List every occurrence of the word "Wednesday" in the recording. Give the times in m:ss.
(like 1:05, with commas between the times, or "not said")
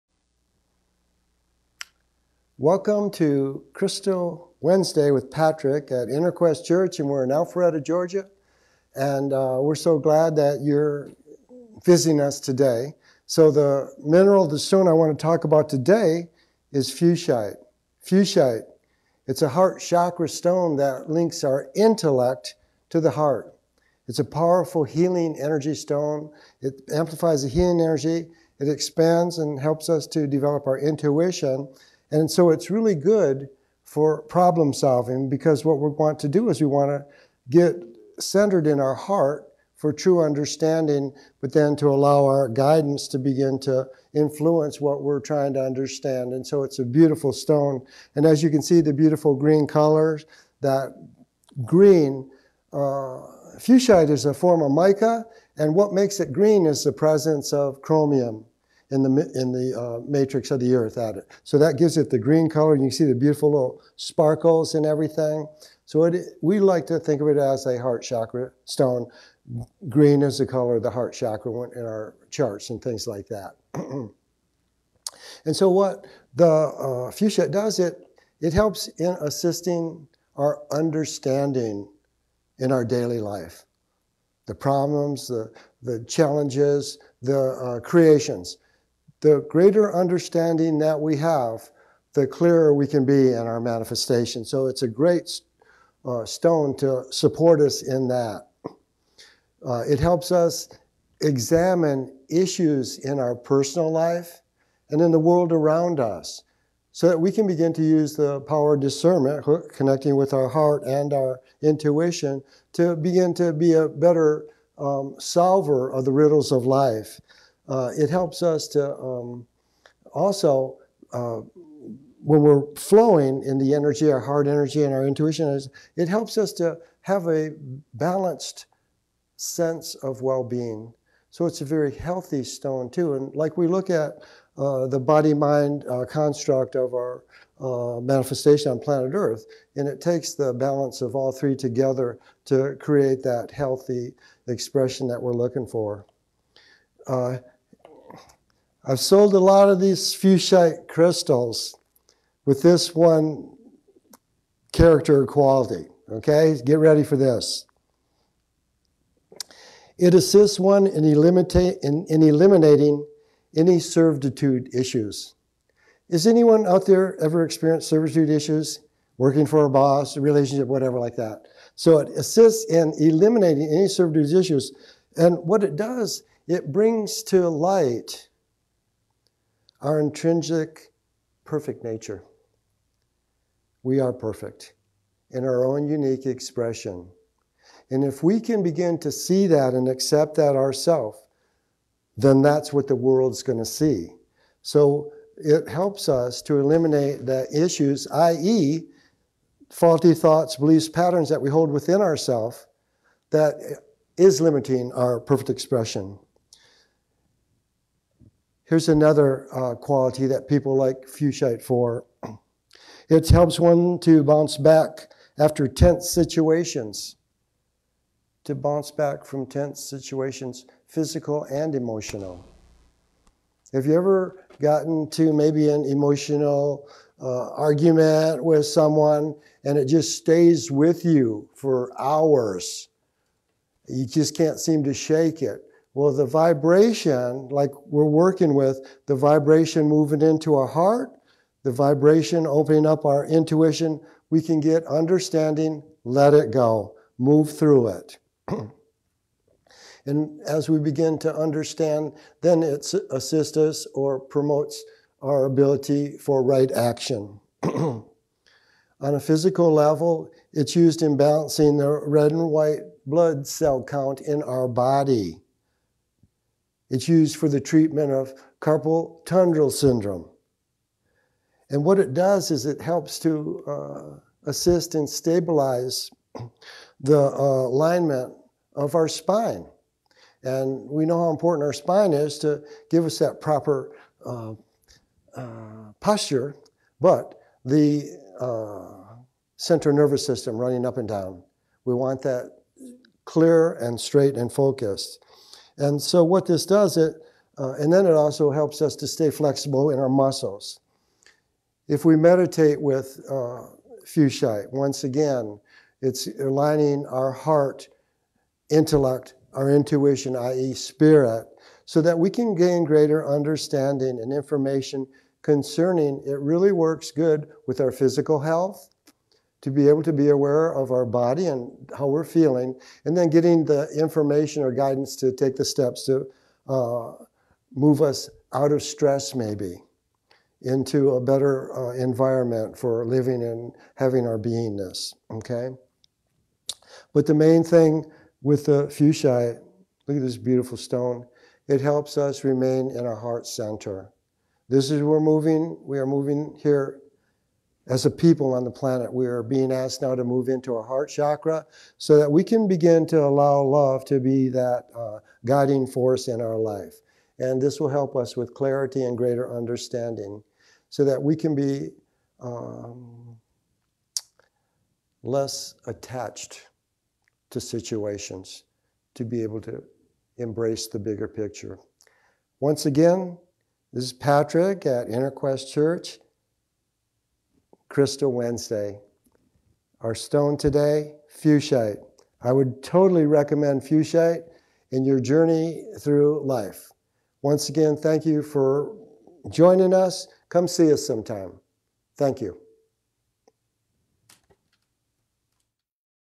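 0:04, 6:18.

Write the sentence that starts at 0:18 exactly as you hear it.
Fuchsite, it's a heart chakra stone that links our intellect to the heart.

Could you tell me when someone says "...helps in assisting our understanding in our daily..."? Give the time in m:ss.
1:18.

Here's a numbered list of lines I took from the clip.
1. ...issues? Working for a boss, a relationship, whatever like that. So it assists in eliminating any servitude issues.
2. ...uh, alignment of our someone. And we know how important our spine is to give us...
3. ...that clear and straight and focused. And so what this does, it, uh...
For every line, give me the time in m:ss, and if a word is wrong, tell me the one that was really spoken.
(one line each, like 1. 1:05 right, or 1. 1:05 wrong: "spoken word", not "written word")
1. 2:48 right
2. 4:37 wrong: "spine", not "someone"
3. 4:52 right.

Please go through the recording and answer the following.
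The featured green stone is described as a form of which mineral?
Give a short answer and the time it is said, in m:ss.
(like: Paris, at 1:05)
Mica, at 0:54.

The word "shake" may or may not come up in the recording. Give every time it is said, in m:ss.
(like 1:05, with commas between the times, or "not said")
3:54.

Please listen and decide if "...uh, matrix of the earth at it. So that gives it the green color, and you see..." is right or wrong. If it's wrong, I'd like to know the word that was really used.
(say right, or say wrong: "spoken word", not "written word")
right.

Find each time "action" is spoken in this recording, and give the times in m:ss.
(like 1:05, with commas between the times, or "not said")
4:16.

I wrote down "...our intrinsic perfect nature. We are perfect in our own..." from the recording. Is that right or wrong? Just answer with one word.
right.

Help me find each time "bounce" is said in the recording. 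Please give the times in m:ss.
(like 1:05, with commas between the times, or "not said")
3:34, 3:38.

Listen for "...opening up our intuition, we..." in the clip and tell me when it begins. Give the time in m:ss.
4:02.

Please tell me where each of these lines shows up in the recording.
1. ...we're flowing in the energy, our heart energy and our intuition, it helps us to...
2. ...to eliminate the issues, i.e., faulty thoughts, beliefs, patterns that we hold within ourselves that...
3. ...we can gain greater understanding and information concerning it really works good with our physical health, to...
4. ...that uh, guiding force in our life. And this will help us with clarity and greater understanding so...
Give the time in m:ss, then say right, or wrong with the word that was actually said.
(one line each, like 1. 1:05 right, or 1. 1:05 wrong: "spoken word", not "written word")
1. 2:02 right
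2. 3:16 right
3. 5:12 right
4. 5:54 right.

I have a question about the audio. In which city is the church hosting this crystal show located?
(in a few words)
Alpharetta, Georgia.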